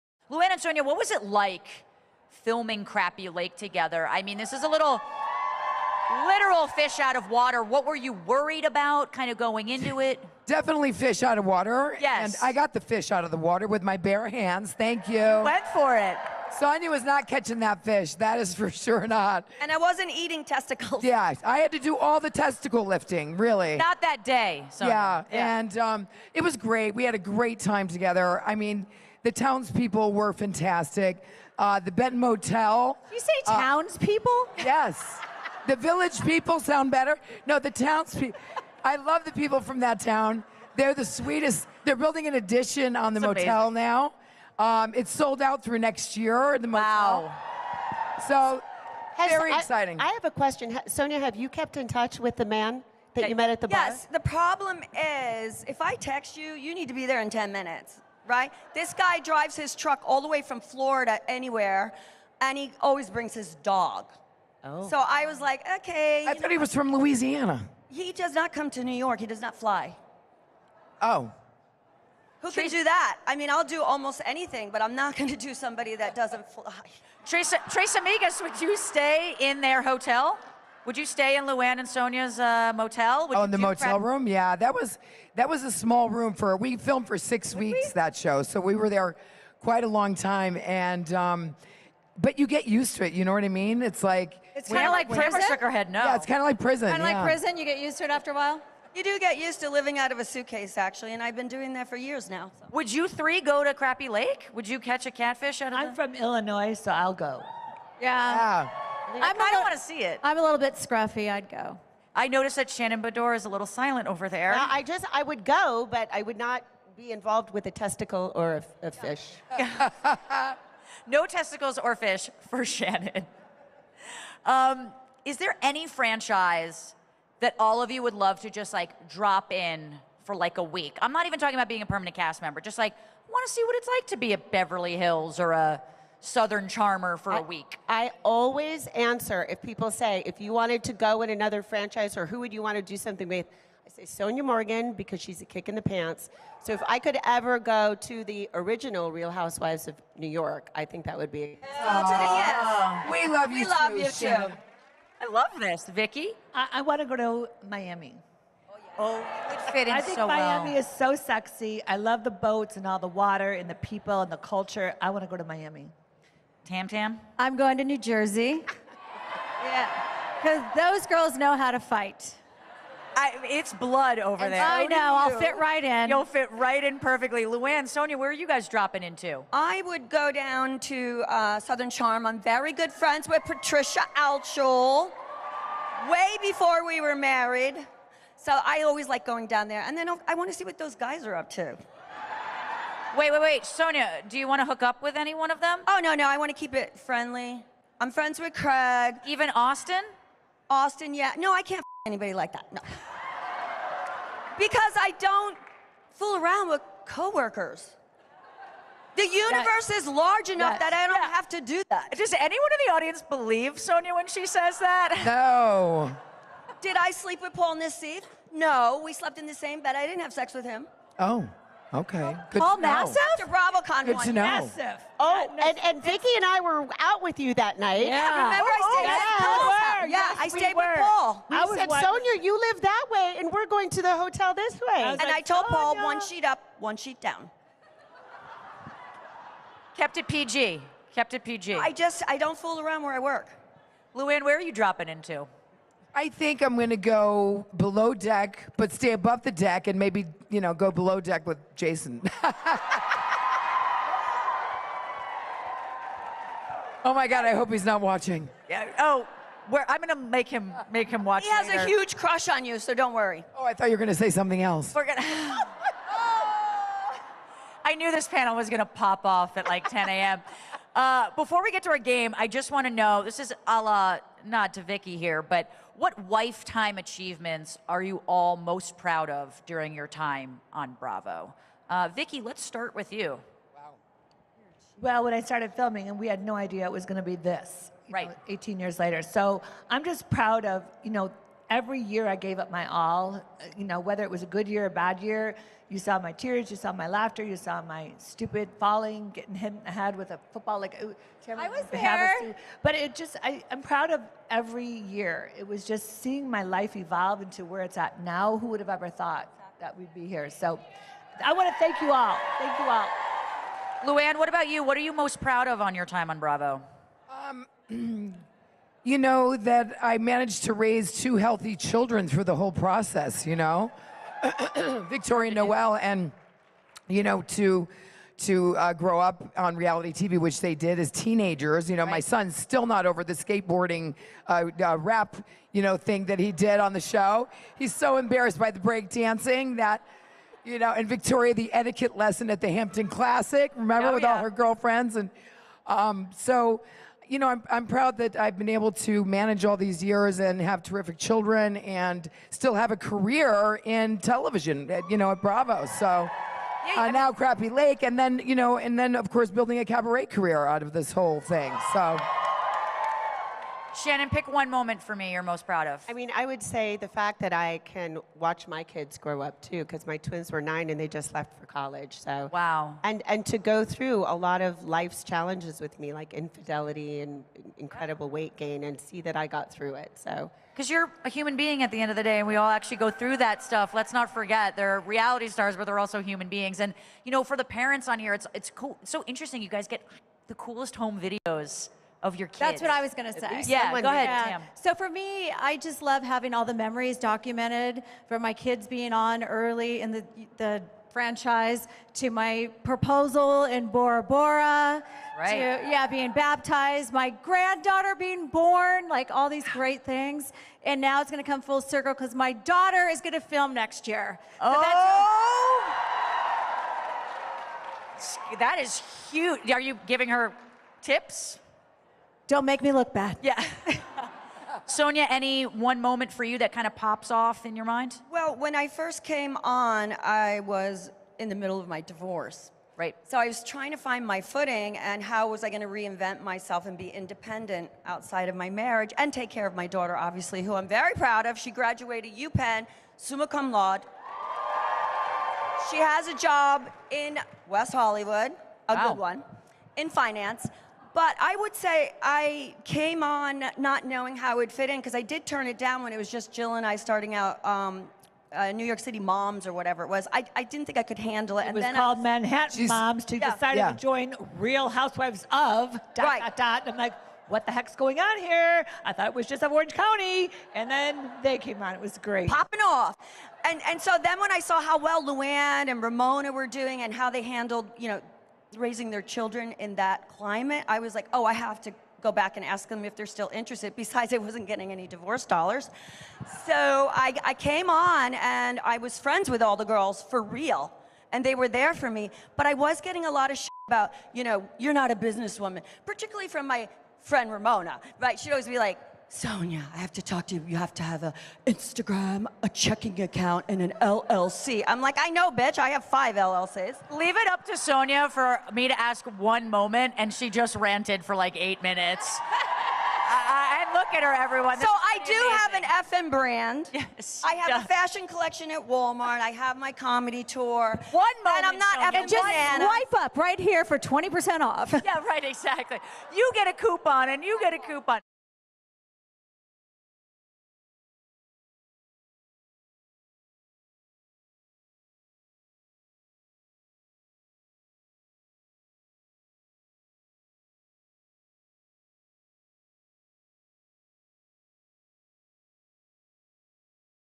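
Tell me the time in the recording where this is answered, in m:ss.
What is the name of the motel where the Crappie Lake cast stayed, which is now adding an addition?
0:31.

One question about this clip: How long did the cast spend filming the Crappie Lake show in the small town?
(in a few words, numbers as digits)
six weeks.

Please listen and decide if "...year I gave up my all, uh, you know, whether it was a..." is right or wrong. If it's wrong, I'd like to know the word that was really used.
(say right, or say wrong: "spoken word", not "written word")
right.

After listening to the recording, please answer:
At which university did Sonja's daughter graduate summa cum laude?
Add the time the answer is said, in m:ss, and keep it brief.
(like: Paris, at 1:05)
UPenn, at 7:22.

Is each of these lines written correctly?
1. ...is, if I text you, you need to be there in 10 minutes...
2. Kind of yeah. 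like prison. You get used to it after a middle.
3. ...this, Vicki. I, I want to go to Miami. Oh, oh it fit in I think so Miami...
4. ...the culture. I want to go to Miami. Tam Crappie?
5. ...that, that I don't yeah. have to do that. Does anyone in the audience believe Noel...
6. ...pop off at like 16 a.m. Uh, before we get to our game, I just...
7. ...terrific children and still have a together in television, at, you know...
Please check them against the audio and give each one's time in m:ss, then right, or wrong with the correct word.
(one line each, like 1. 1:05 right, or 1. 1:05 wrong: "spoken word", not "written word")
1. 0:55 right
2. 1:36 wrong: "while", not "middle"
3. 2:35 right
4. 2:44 wrong: "Tam", not "Crappie"
5. 3:30 wrong: "Sonja", not "Noel"
6. 4:28 wrong: "10", not "16"
7. 5:50 wrong: "career", not "together".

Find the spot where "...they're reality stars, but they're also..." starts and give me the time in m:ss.
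6:24.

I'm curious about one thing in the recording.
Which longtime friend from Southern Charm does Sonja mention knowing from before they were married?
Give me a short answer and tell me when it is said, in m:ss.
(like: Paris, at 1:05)
Patricia Altschul, at 3:03.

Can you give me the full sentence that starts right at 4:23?
Oh, I thought you were gonna say something else.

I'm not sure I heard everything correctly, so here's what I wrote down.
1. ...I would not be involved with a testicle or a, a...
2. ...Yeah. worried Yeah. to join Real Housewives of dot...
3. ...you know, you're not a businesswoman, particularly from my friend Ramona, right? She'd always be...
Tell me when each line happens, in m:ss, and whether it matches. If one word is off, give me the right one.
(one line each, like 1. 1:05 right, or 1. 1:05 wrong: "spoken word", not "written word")
1. 1:56 right
2. 7:43 wrong: "decided", not "worried"
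3. 8:14 right.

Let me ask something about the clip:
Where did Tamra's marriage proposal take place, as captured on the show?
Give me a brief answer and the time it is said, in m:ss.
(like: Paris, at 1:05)
Bora Bora, at 6:43.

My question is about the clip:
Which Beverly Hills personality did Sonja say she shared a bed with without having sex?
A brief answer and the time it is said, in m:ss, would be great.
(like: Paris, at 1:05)
Paul Nassif, at 3:37.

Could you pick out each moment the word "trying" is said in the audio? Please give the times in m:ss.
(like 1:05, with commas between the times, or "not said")
7:13.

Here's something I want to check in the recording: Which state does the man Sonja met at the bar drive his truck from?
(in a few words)
Florida.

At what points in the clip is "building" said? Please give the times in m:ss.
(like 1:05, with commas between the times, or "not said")
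0:41, 5:59.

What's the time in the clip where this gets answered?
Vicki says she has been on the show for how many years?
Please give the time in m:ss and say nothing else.
4:48.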